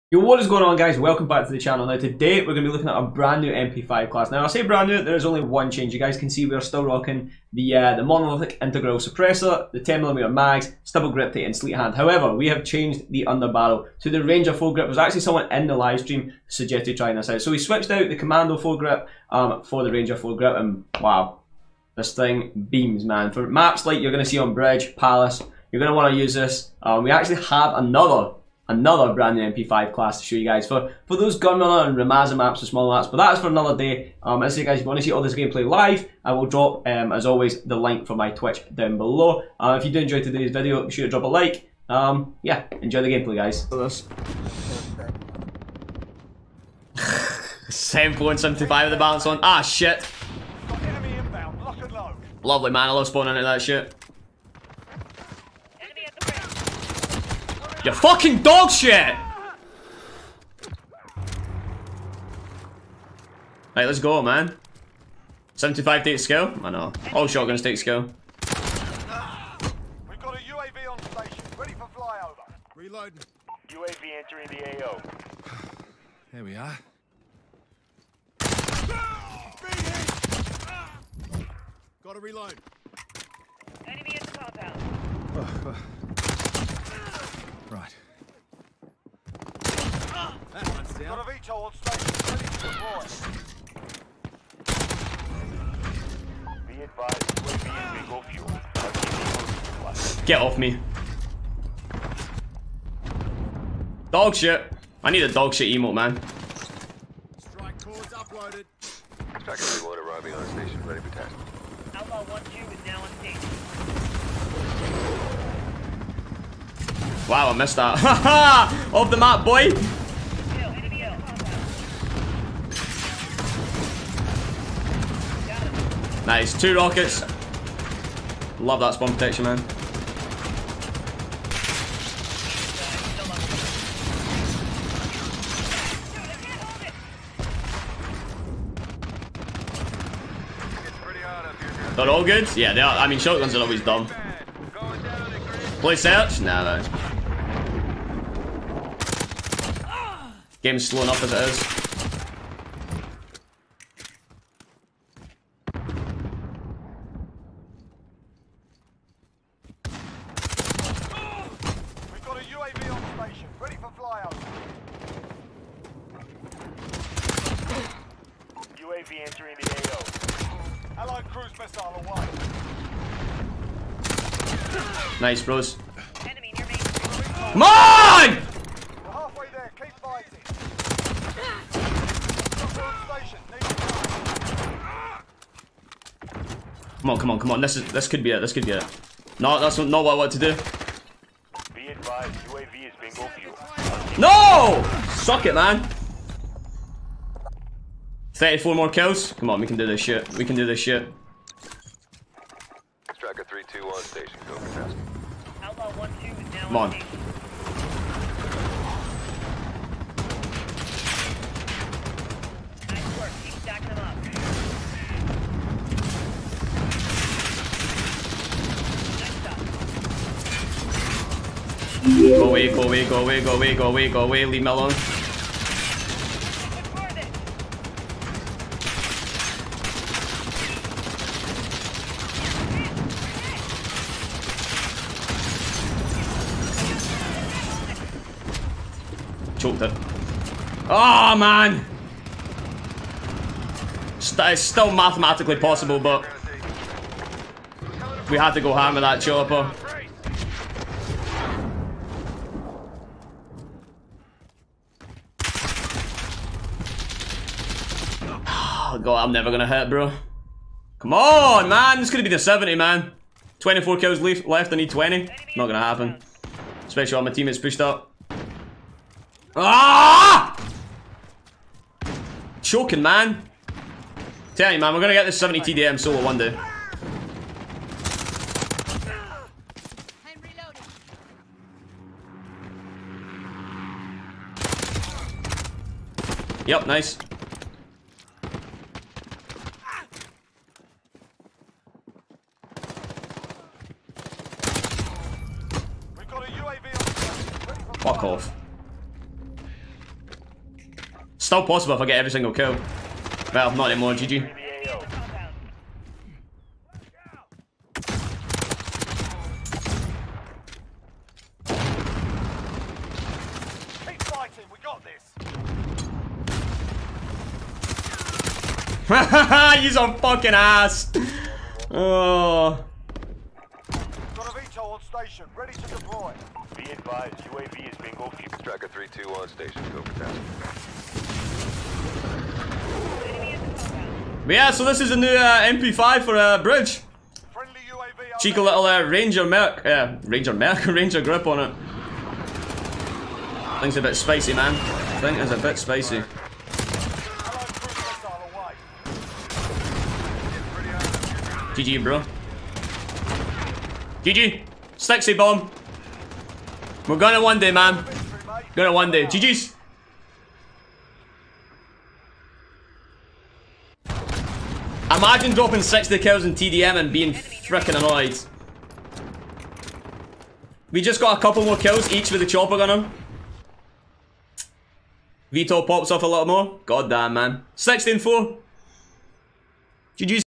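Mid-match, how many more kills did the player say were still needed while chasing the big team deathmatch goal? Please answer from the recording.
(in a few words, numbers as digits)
34.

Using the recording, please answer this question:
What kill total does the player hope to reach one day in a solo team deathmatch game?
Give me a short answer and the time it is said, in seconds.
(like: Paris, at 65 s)
70, at 275 s.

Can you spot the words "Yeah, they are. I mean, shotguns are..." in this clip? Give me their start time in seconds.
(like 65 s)
142 s.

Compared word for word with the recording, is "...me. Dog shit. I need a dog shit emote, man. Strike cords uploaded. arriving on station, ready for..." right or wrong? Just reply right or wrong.
right.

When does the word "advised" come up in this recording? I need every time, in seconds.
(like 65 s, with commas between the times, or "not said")
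96 s, 326 s.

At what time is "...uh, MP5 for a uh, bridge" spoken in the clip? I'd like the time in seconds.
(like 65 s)
335 s.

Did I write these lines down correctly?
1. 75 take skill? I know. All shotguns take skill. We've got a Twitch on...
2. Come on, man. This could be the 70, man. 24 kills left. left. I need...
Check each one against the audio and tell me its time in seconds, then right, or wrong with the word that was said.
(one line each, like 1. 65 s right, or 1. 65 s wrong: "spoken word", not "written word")
1. 65 s wrong: "UAV", not "Twitch"
2. 260 s right.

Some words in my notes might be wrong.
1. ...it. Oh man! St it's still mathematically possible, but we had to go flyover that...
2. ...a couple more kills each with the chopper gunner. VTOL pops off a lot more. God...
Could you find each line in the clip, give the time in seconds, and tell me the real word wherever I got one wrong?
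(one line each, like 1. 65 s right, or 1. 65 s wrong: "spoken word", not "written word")
1. 239 s wrong: "hammer", not "flyover"
2. 371 s right.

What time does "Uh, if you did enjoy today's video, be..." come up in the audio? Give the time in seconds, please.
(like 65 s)
39 s.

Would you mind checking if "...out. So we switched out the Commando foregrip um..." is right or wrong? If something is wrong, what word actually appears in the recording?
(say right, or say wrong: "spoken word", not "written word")
right.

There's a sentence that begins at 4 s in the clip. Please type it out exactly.
Now I say brand new, there's only one change.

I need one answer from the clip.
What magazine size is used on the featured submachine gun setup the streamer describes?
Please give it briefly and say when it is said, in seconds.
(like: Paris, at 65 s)
10mm mags, at 9 s.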